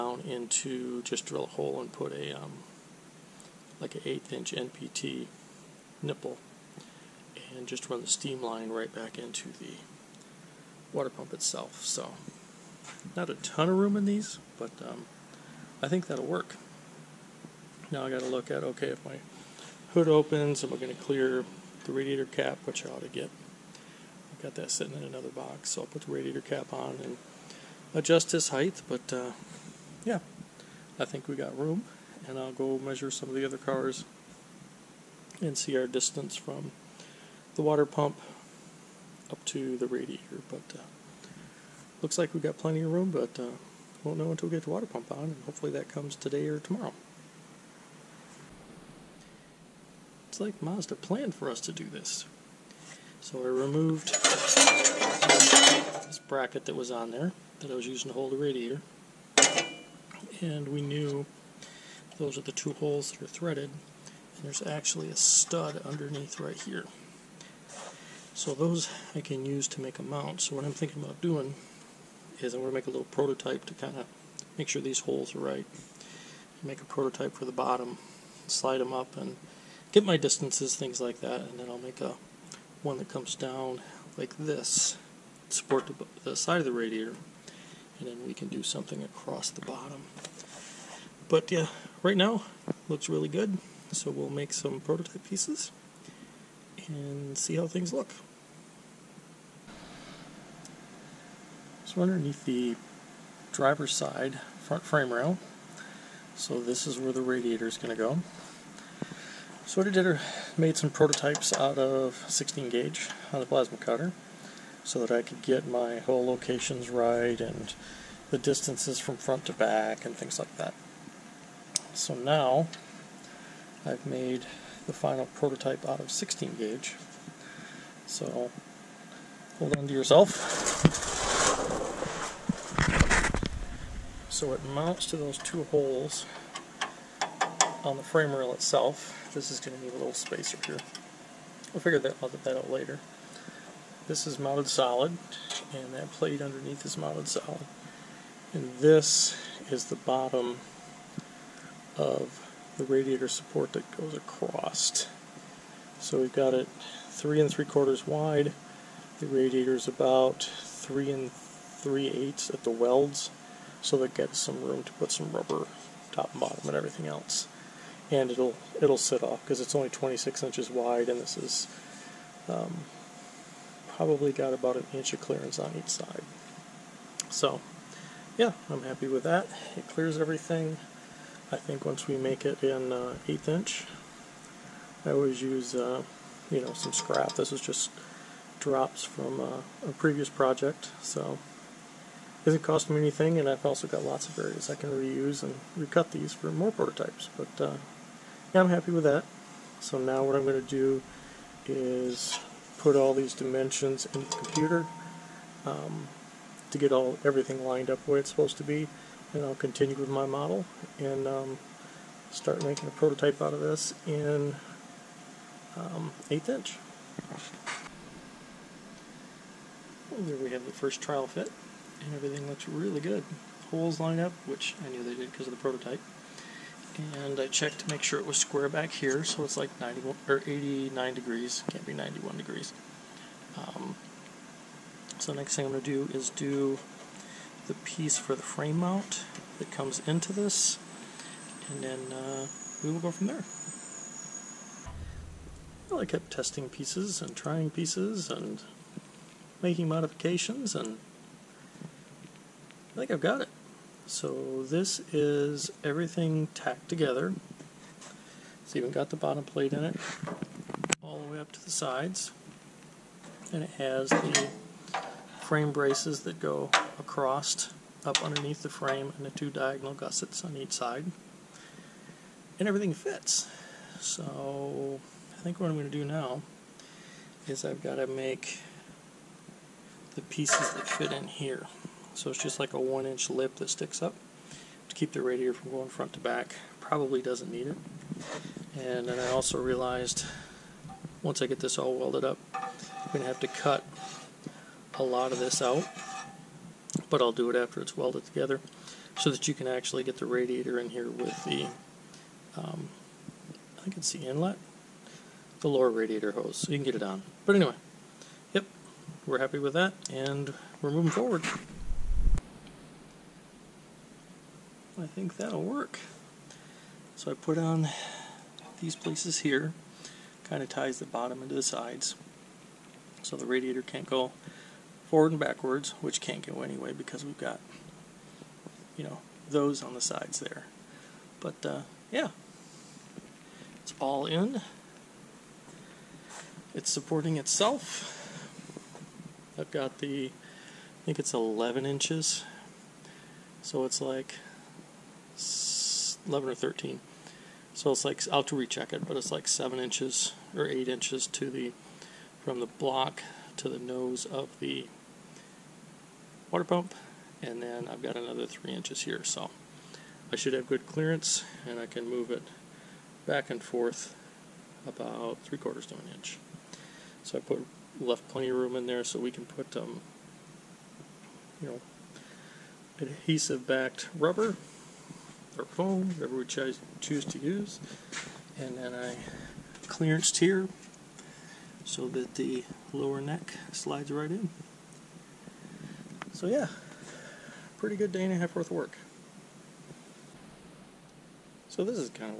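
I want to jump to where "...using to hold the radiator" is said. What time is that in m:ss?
0:57.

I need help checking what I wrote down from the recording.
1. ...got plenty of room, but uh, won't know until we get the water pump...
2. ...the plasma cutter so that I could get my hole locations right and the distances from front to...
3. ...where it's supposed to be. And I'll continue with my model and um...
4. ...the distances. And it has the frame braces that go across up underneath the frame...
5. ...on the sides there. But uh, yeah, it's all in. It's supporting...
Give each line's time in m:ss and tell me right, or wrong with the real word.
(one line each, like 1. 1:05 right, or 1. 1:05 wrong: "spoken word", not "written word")
1. 0:42 right
2. 1:53 right
3. 3:28 right
4. 4:21 wrong: "sides", not "distances"
5. 5:29 right.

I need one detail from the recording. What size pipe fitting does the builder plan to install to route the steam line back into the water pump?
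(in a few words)
1/8 inch NPT nipple.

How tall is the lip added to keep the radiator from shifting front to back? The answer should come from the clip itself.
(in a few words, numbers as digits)
1 inch.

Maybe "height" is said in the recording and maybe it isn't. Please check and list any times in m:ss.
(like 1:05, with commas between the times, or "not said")
0:28.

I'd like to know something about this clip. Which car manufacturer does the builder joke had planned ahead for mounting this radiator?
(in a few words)
Mazda.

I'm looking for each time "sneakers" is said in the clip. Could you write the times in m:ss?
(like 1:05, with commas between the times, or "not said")
not said.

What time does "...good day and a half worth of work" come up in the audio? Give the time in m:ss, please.
6:27.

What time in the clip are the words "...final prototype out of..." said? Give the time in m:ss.
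2:04.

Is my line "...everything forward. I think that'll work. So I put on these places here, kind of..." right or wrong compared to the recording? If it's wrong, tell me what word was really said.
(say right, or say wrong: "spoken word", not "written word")
wrong: "moving", not "everything".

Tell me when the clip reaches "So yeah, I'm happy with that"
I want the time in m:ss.
2:57.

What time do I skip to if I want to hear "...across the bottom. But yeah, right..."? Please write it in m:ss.
1:29.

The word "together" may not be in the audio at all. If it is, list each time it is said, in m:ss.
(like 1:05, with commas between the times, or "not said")
4:16, 4:58.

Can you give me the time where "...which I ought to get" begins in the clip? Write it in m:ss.
0:22.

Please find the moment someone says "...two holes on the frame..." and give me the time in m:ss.
2:15.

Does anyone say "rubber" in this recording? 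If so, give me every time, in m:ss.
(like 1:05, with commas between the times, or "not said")
2:45, 6:14.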